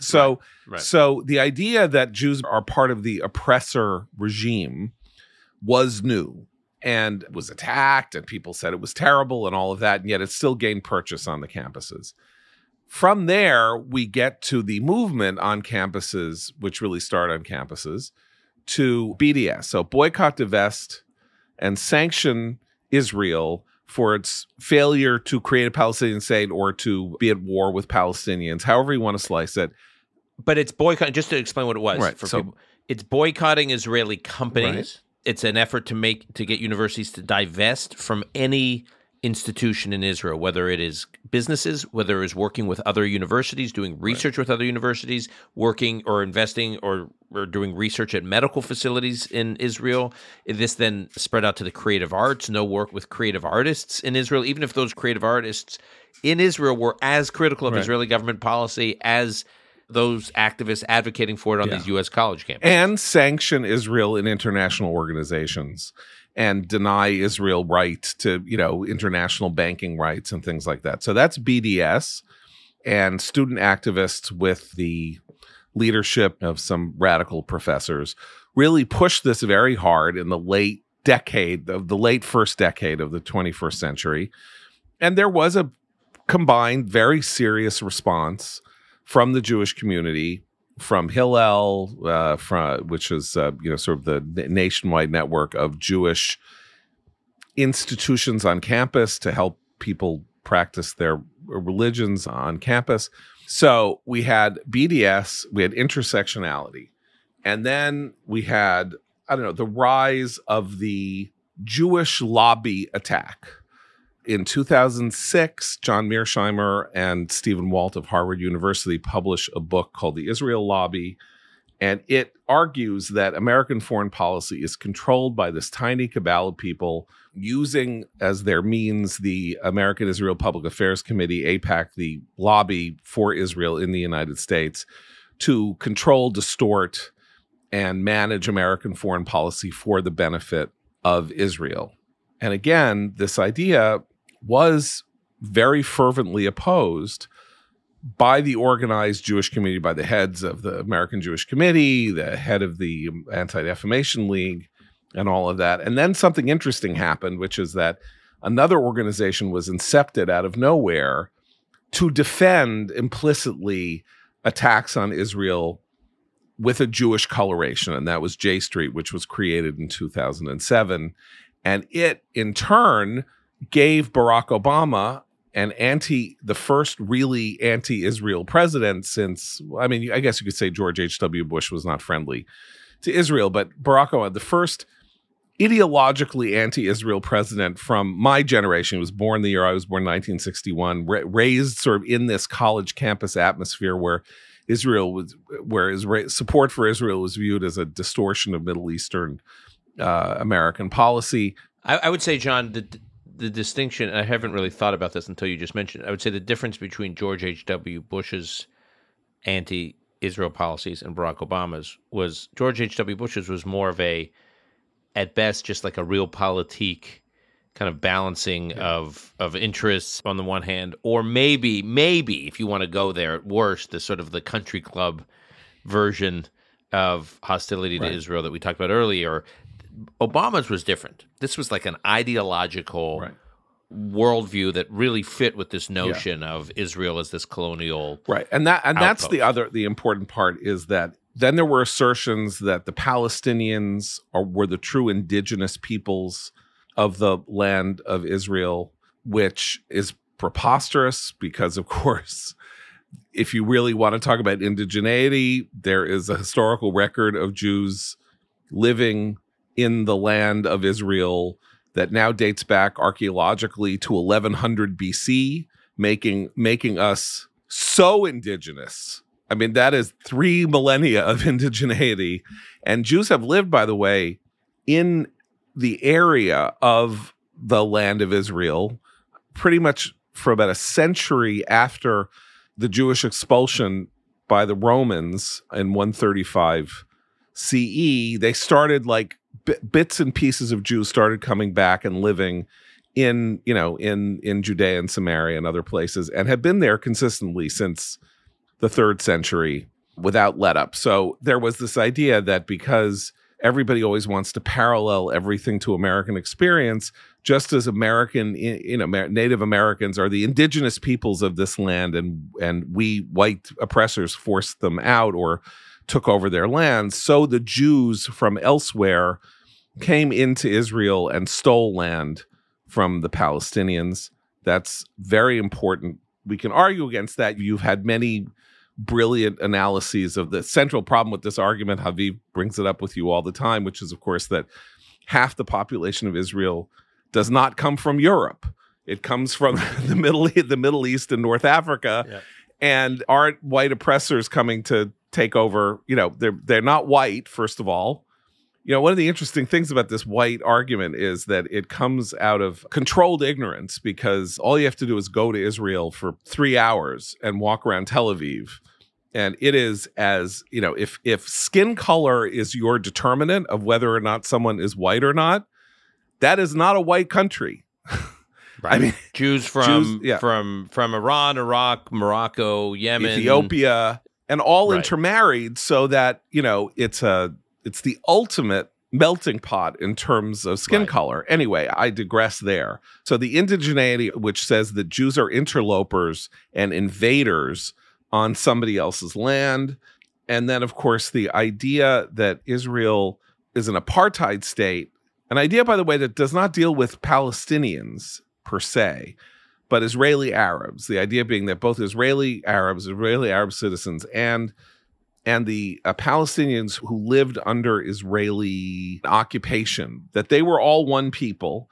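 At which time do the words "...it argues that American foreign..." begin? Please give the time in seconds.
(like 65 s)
122 s.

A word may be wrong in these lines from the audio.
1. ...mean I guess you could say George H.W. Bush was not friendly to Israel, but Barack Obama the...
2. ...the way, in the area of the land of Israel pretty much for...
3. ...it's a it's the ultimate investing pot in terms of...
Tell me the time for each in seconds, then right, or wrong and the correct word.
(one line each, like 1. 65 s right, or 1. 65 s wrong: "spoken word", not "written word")
1. 179 s right
2. 273 s right
3. 376 s wrong: "melting", not "investing".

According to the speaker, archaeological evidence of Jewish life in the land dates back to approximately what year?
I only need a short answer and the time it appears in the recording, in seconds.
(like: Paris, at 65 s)
1100 BC, at 264 s.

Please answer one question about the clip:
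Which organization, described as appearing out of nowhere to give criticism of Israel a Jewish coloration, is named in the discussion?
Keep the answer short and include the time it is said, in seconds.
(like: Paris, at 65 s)
J Street, at 168 s.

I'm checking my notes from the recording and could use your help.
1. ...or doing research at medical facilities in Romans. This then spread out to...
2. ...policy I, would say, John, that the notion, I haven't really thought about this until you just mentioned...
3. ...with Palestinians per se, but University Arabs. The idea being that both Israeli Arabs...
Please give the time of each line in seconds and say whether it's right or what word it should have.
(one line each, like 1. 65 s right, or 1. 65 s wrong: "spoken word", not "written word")
1. 47 s wrong: "Israel", not "Romans"
2. 200 s wrong: "distinction", not "notion"
3. 396 s wrong: "Israeli", not "University".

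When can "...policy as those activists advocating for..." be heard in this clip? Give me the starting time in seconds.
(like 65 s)
58 s.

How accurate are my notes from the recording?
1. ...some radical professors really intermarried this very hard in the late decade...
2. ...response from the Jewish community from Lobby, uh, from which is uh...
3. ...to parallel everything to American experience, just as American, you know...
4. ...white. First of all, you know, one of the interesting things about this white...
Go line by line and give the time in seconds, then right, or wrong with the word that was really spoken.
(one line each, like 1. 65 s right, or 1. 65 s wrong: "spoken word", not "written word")
1. 76 s wrong: "pushed", not "intermarried"
2. 87 s wrong: "Hillel", not "Lobby"
3. 304 s right
4. 347 s right.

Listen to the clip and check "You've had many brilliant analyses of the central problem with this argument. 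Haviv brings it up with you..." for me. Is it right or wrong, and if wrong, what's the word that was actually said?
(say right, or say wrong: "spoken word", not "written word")
right.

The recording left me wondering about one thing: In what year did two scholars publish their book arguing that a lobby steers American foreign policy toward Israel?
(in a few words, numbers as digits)
2006.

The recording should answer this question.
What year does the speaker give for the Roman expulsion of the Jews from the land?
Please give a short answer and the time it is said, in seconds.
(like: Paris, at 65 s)
135 CE, at 285 s.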